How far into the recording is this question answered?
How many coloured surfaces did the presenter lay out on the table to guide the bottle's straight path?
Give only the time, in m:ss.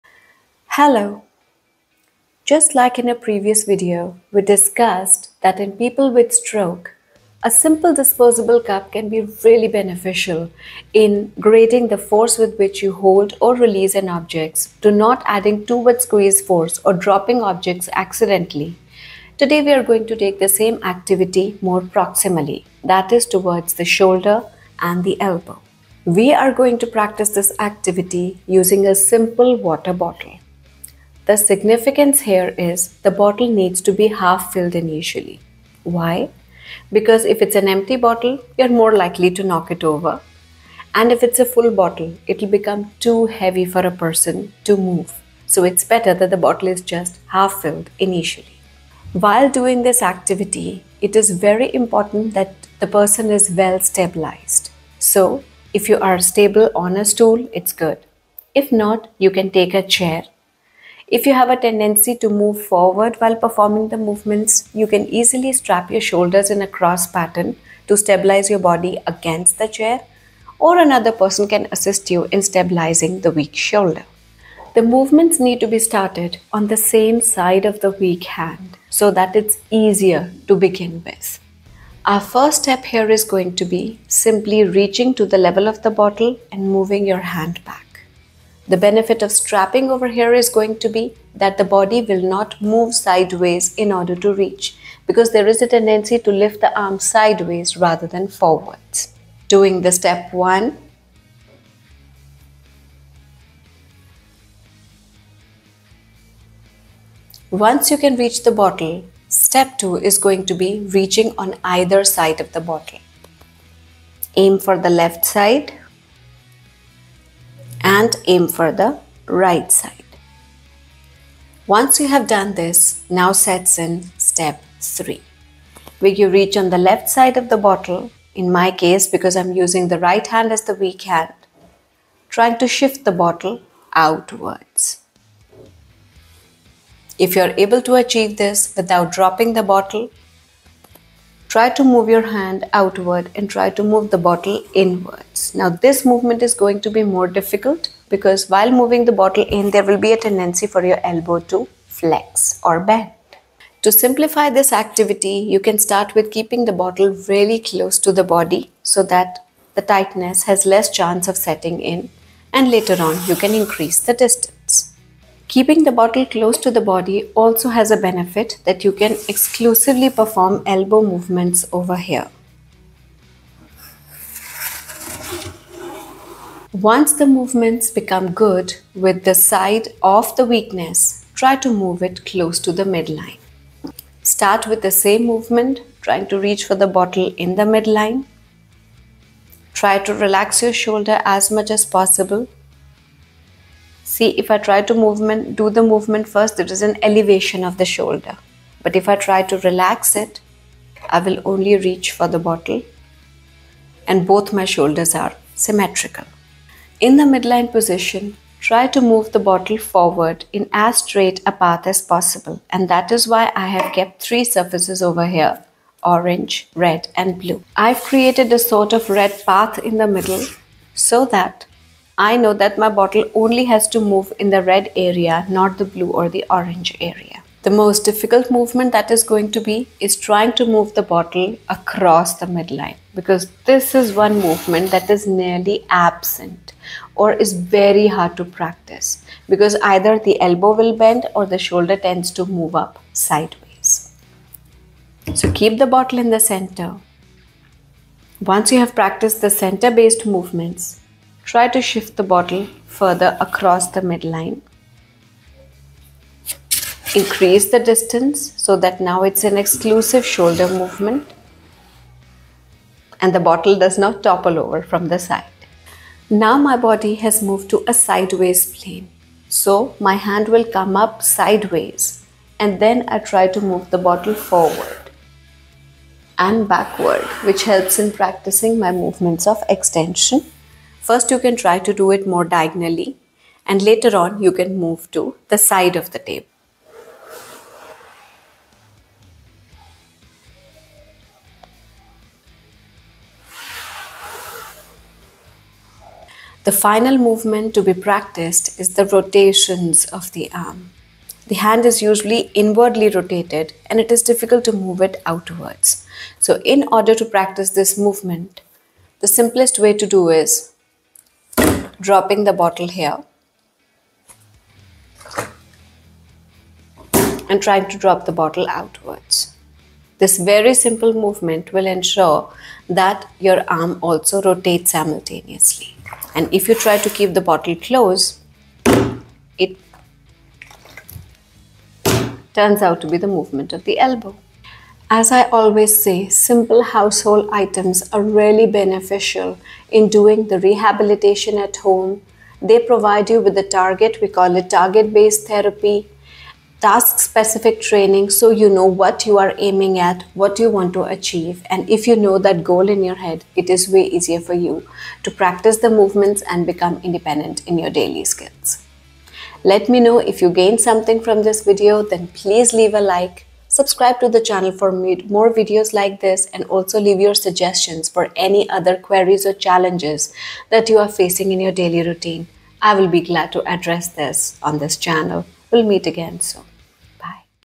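3:34.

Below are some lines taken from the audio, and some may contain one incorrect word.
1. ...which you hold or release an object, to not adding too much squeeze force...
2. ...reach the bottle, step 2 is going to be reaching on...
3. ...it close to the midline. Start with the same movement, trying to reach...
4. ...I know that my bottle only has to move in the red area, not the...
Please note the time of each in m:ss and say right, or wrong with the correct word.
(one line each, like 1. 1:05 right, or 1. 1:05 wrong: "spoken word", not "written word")
1. 0:12 right
2. 1:48 right
3. 3:02 right
4. 3:42 right.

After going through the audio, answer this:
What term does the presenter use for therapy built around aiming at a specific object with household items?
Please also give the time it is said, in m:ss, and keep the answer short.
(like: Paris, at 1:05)
Target based therapy, at 5:44.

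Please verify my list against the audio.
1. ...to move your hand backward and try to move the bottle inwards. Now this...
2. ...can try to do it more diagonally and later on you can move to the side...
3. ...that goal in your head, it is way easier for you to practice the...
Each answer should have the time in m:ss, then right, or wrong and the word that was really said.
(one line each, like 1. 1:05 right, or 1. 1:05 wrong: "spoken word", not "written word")
1. 2:21 wrong: "outward", not "backward"
2. 4:41 right
3. 5:52 right.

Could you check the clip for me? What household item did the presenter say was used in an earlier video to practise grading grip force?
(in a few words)
Disposable cup.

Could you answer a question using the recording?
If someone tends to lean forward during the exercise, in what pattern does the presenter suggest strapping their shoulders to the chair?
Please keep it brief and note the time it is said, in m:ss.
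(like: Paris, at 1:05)
Cross pattern, at 1:06.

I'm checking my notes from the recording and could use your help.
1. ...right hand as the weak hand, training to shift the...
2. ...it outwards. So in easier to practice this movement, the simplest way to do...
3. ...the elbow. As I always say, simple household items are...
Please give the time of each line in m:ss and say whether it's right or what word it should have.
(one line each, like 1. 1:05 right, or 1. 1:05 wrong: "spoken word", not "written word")
1. 2:10 wrong: "trying", not "training"
2. 5:05 wrong: "order", not "easier"
3. 5:33 right.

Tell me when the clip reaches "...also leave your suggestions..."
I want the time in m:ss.
6:06.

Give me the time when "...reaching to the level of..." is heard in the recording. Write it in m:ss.
1:24.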